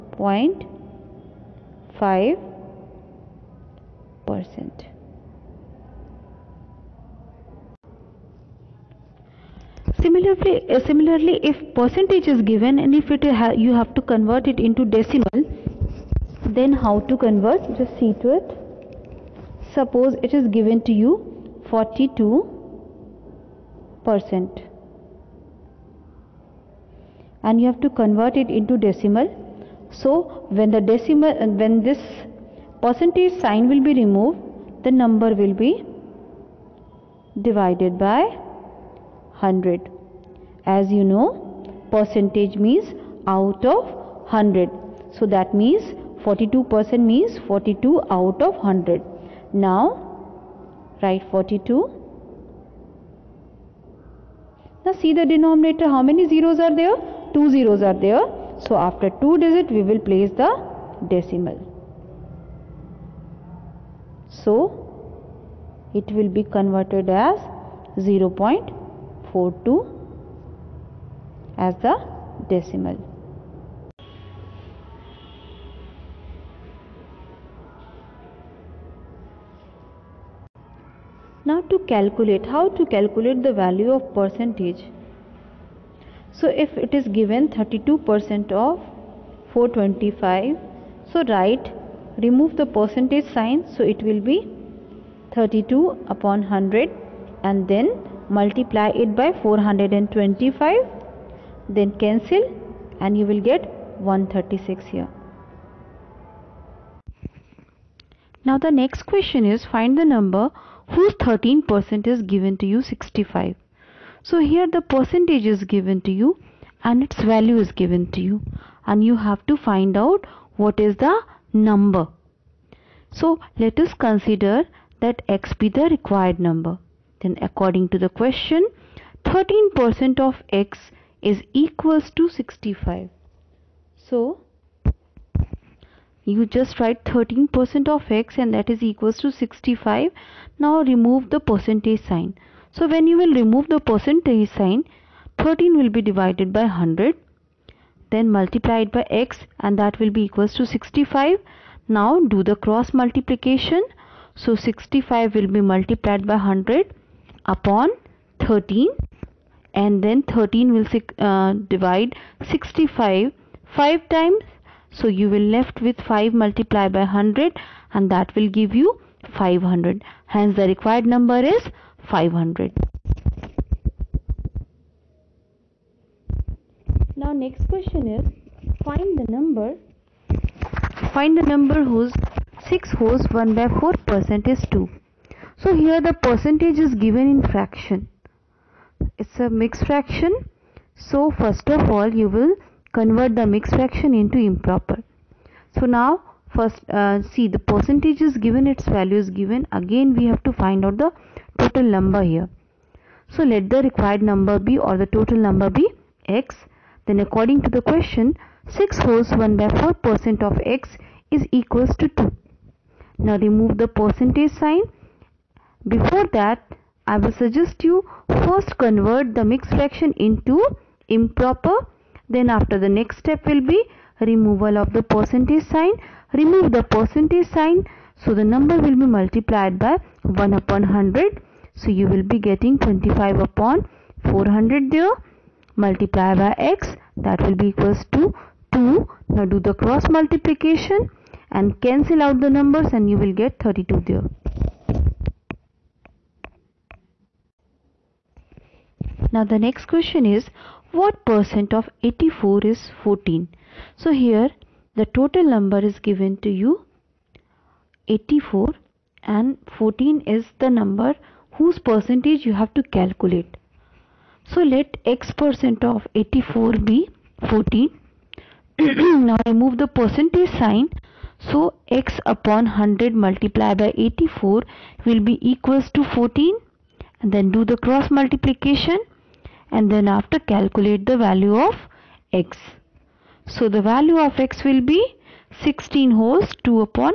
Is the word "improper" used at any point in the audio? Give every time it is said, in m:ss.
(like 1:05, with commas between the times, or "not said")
3:14, 3:41.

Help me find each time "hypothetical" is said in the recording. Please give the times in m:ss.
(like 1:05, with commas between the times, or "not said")
not said.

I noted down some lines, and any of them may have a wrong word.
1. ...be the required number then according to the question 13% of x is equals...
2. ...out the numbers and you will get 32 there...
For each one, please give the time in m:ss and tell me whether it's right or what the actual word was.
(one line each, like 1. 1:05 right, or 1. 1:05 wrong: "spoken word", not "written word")
1. 2:05 right
2. 4:02 right.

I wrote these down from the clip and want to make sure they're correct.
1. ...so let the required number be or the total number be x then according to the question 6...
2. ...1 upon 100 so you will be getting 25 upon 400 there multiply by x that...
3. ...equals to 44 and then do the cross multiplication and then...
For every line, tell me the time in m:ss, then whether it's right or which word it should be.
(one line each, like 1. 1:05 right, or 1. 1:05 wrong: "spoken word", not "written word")
1. 3:23 right
2. 3:50 right
3. 4:35 wrong: "14", not "44".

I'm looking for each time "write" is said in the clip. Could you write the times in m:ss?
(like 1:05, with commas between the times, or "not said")
0:51, 1:31, 2:16.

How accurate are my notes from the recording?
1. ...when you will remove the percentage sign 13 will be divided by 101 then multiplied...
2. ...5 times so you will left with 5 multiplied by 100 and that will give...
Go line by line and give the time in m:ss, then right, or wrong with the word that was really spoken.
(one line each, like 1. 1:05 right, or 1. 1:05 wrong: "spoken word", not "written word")
1. 2:22 wrong: "100", not "101"
2. 2:43 right.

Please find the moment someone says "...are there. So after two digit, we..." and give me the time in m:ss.
0:57.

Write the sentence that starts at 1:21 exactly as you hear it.
Now to calculate, how to calculate the value of percentage?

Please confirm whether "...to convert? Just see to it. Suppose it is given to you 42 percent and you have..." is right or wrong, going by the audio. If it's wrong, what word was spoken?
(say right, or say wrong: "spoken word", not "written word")
right.